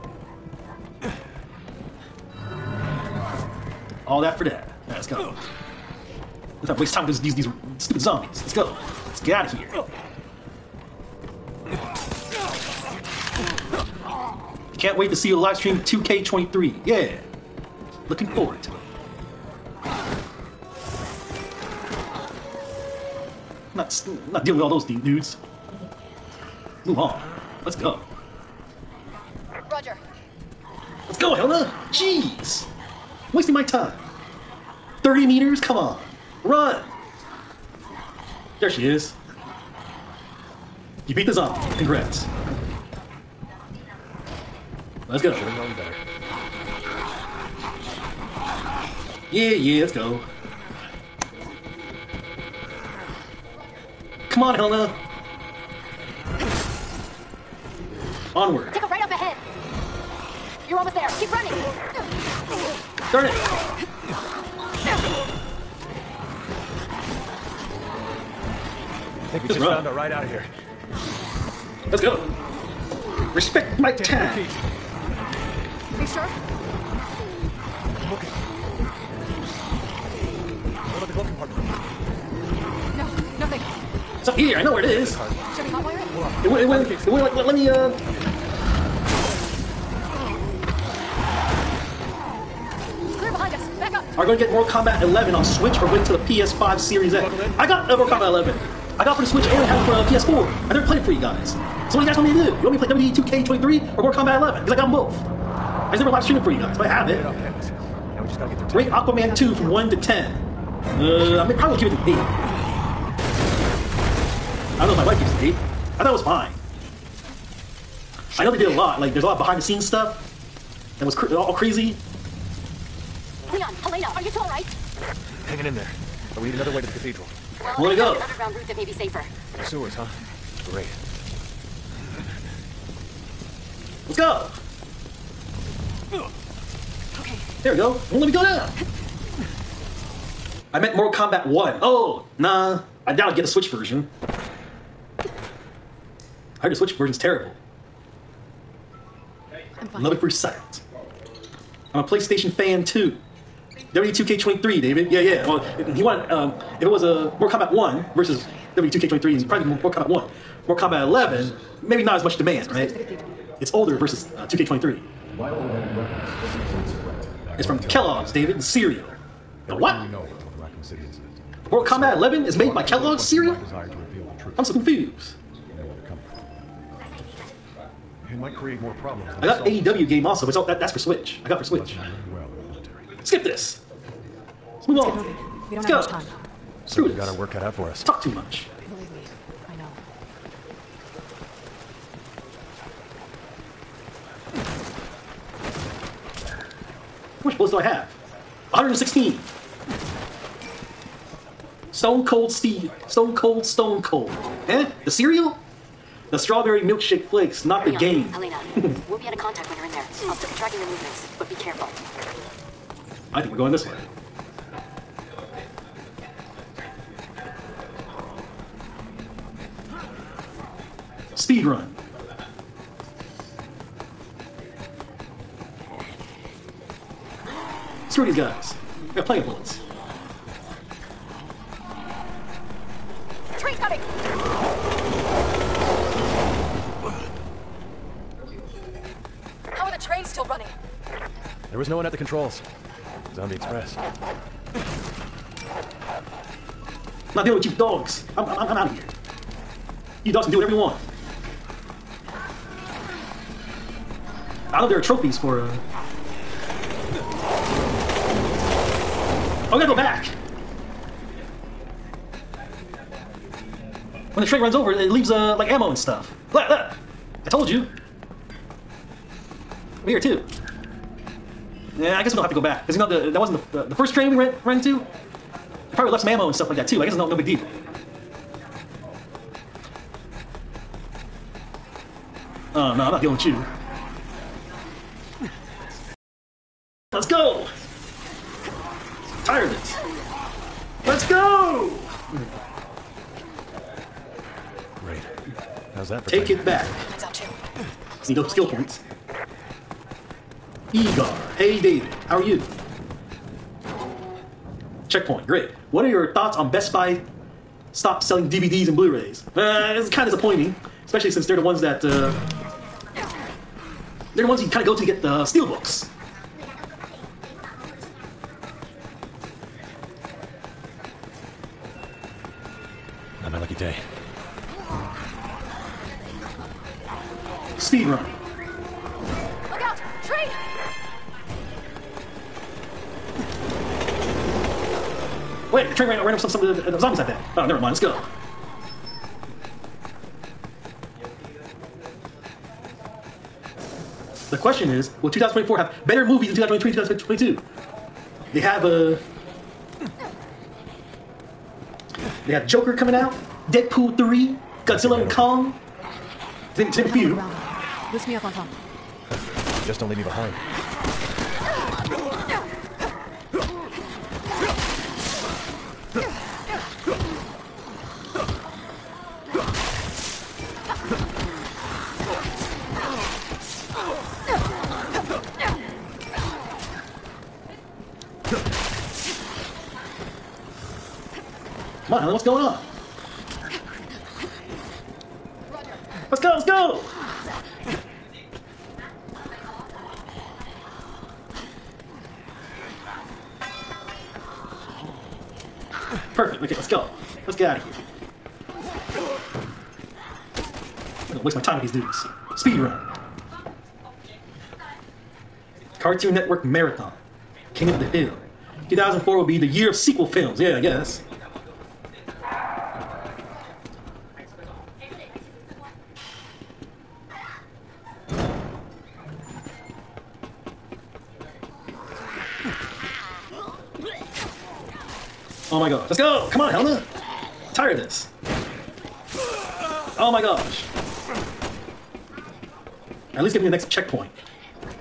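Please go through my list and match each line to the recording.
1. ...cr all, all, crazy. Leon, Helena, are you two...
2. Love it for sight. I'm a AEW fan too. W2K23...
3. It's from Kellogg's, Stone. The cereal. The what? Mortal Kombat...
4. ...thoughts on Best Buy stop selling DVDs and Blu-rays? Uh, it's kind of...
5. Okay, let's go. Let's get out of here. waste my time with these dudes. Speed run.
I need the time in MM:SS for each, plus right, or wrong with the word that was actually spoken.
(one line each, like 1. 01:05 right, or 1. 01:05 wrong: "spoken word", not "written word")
1. 02:01 right
2. 02:30 wrong: "PlayStation", not "AEW"
3. 02:47 wrong: "David", not "Stone"
4. 05:06 right
5. 06:36 right.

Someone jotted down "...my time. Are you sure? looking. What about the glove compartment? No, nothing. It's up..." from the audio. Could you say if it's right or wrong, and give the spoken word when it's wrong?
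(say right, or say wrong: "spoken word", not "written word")
right.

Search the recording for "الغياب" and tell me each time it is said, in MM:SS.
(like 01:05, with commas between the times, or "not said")
not said.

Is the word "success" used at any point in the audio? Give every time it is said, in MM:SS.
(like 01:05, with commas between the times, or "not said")
not said.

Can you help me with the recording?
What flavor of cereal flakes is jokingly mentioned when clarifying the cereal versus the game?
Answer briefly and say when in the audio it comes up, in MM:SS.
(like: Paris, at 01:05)
Strawberry milkshake, at 03:26.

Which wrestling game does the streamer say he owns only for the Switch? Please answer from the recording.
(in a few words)
AEW.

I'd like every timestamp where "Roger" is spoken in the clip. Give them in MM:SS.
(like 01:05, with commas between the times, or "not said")
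00:29.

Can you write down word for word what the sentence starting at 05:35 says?
Wait, the train ran, ran over some, some of the, the zombies like that.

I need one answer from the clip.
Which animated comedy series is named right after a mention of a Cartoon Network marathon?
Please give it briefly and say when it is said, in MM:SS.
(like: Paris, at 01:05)
King of the Hill, at 06:47.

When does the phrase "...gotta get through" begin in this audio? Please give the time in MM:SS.
01:48.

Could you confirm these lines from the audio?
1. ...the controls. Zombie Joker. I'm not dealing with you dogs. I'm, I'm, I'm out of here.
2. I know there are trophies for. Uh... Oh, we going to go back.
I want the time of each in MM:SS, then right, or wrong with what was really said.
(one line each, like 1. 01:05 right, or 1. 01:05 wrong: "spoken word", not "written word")
1. 04:02 wrong: "Express", not "Joker"
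2. 04:14 right.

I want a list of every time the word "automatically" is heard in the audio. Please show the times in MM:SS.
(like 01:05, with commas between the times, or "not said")
not said.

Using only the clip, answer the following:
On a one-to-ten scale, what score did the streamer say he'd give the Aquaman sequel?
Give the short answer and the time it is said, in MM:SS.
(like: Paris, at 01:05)
8, at 01:52.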